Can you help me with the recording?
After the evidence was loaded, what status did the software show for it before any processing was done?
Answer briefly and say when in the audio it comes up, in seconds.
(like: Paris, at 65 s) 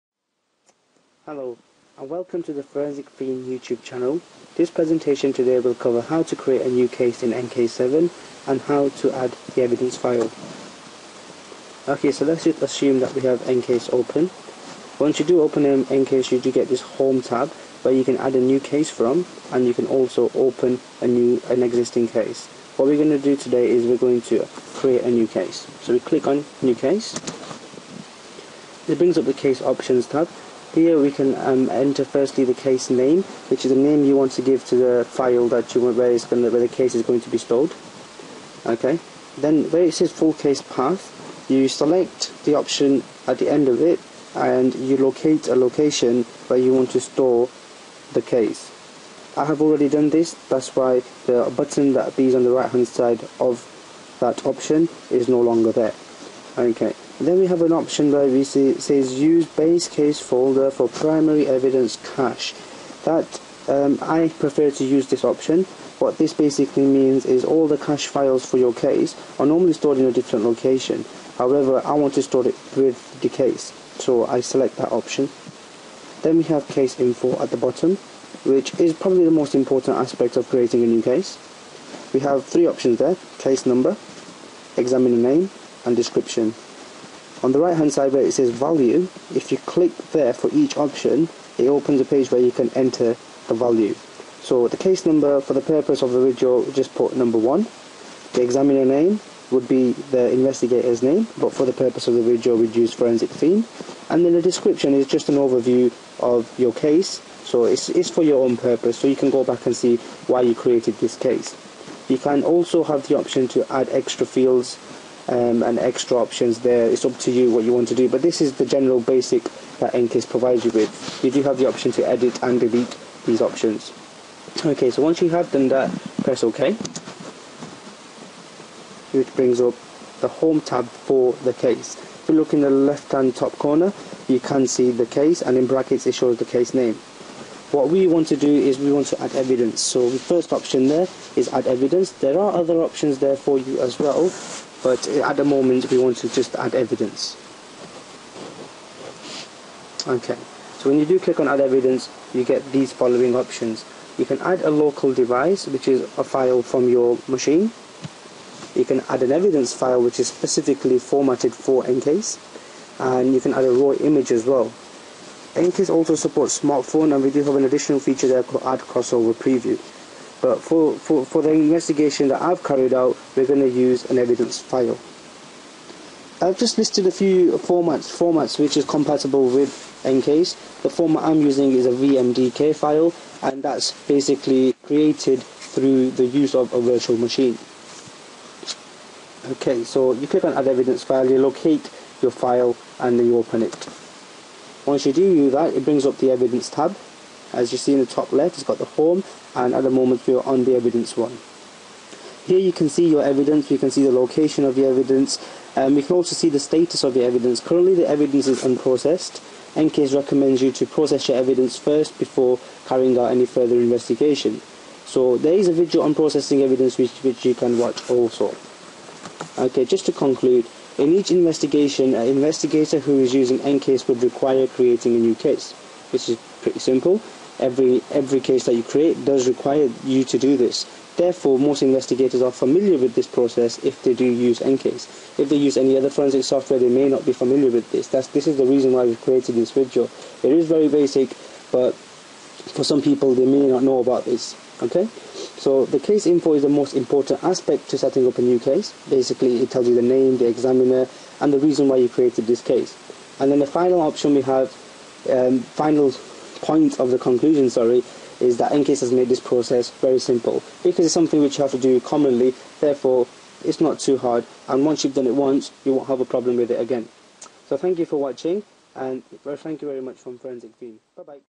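Unprocessed, at 208 s.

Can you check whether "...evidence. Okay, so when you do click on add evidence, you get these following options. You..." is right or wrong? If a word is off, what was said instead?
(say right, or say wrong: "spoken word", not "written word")
right.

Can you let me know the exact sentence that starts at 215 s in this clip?
So there is a video on processing evidence which, which you can watch also.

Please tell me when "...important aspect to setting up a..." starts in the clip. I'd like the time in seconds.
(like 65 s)
246 s.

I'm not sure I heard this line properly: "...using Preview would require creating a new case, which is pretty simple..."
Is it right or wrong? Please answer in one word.
wrong.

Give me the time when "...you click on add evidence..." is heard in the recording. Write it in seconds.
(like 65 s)
190 s.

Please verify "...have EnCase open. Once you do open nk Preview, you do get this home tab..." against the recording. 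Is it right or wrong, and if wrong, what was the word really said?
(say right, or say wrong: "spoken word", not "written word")
wrong: "EnCase", not "Preview".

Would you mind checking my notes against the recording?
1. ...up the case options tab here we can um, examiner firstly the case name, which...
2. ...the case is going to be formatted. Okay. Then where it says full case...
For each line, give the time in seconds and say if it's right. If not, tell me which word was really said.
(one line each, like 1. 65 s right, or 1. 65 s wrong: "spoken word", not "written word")
1. 29 s wrong: "enter", not "examiner"
2. 36 s wrong: "stored", not "formatted".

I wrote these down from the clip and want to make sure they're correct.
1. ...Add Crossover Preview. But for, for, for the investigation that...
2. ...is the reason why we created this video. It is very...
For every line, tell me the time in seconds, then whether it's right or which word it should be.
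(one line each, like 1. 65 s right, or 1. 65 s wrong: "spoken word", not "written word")
1. 168 s right
2. 238 s right.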